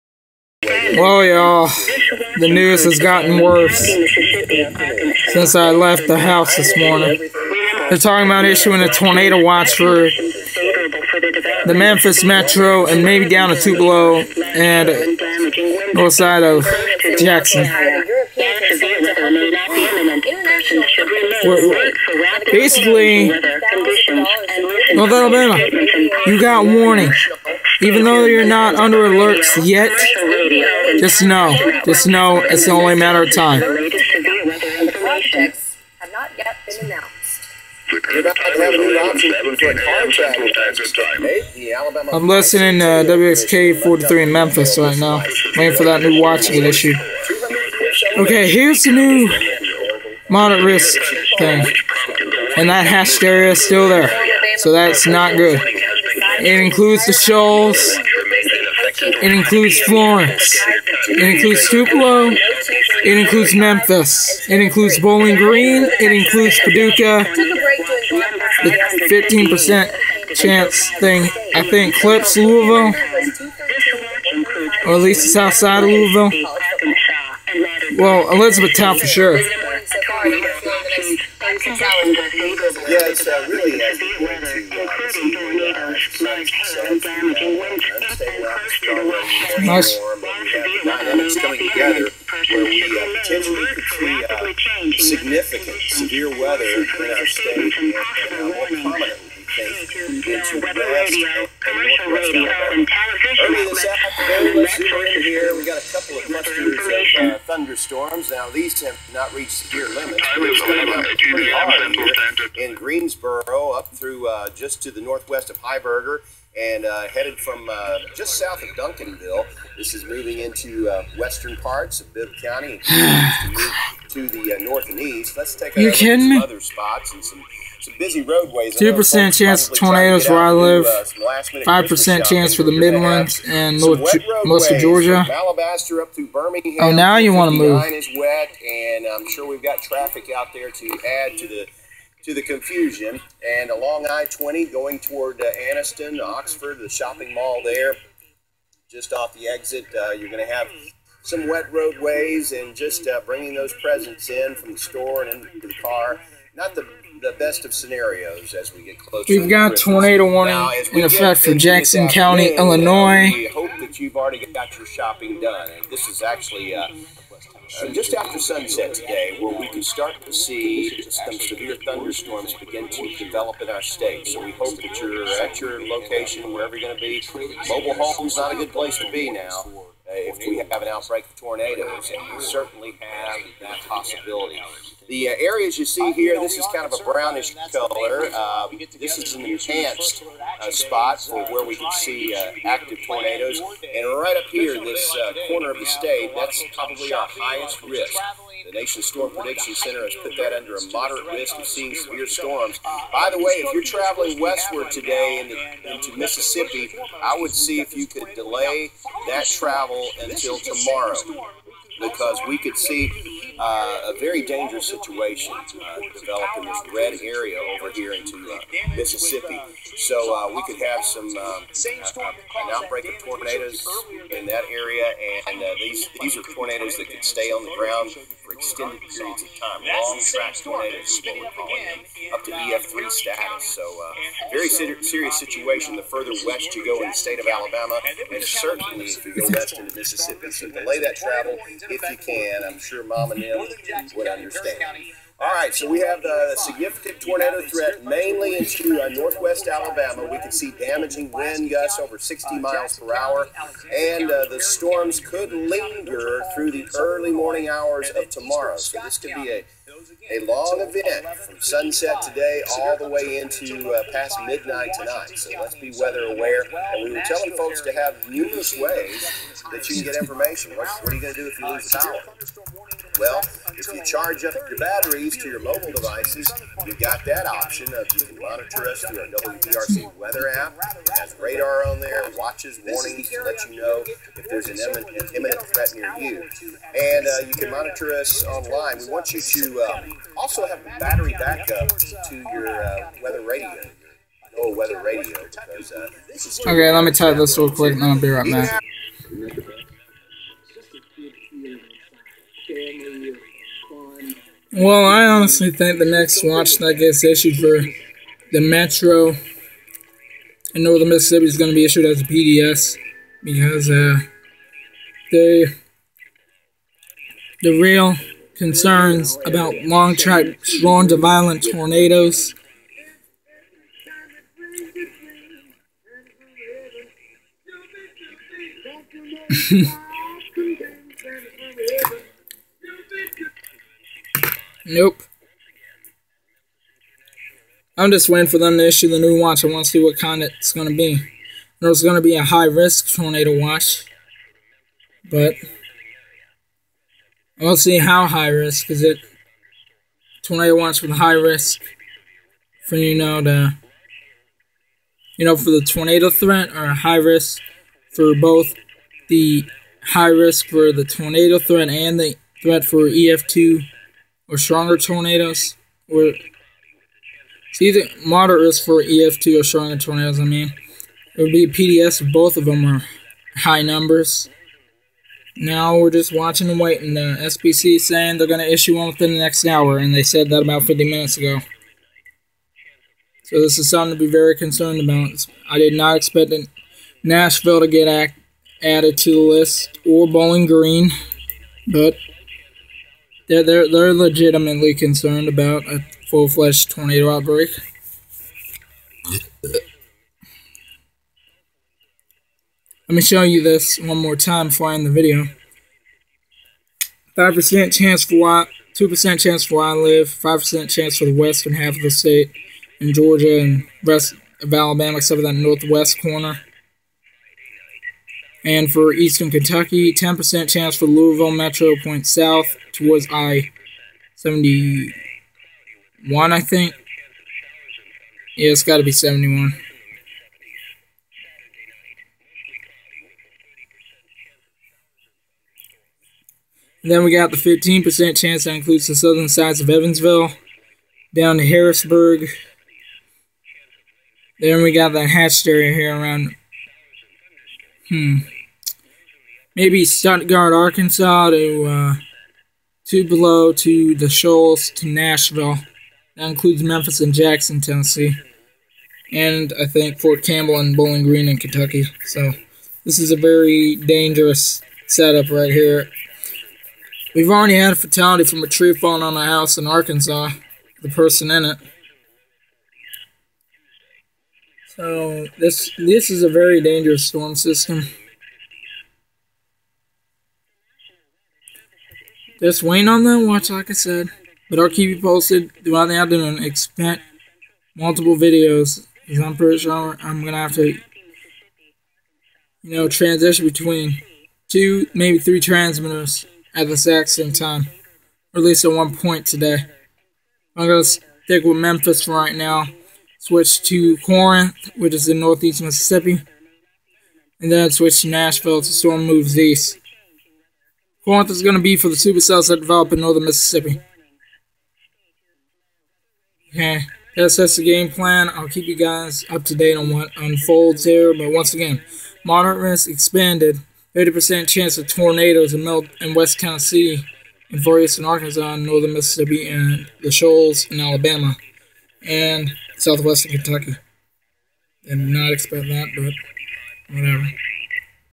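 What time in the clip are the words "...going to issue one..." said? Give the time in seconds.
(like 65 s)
378 s.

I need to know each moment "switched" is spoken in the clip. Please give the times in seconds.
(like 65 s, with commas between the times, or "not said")
503 s, 507 s.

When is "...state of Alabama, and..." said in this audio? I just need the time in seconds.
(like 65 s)
237 s.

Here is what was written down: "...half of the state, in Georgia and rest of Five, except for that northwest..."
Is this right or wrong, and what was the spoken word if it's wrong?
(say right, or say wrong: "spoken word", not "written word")
wrong: "Alabama", not "Five".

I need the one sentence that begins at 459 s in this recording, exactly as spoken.
And I think Fort Campbell and Bowling Green in Kentucky.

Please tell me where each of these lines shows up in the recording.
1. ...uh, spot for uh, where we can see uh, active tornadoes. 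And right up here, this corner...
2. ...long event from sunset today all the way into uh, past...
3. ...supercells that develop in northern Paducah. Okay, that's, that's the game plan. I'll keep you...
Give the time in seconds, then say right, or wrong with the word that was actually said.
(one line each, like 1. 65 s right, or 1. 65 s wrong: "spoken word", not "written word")
1. 190 s right
2. 260 s right
3. 512 s wrong: "Mississippi", not "Paducah".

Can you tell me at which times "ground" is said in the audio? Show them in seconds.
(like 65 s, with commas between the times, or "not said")
227 s.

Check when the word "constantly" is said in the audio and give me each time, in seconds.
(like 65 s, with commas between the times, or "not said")
not said.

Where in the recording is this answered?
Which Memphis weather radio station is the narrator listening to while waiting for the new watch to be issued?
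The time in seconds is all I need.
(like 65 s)
43 s.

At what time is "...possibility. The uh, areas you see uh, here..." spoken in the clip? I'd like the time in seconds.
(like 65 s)
183 s.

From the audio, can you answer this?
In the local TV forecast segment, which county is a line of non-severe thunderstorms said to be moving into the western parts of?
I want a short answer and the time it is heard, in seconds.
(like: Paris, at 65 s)
Bibb County, at 122 s.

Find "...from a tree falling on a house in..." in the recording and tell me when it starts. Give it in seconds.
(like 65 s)
468 s.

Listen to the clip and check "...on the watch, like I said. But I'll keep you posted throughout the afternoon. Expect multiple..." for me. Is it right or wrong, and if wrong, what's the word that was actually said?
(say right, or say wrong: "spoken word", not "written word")
right.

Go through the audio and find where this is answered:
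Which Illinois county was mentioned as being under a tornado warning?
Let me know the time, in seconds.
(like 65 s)
161 s.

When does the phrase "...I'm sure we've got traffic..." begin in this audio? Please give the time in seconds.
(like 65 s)
139 s.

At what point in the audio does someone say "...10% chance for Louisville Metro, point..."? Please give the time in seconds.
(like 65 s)
420 s.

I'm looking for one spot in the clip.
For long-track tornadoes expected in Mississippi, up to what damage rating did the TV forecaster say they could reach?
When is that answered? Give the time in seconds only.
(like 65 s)
232 s.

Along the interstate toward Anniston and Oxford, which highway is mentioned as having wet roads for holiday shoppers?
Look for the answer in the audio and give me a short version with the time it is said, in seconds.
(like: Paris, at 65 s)
I 20, at 144 s.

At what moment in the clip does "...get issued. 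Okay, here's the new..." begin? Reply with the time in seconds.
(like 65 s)
46 s.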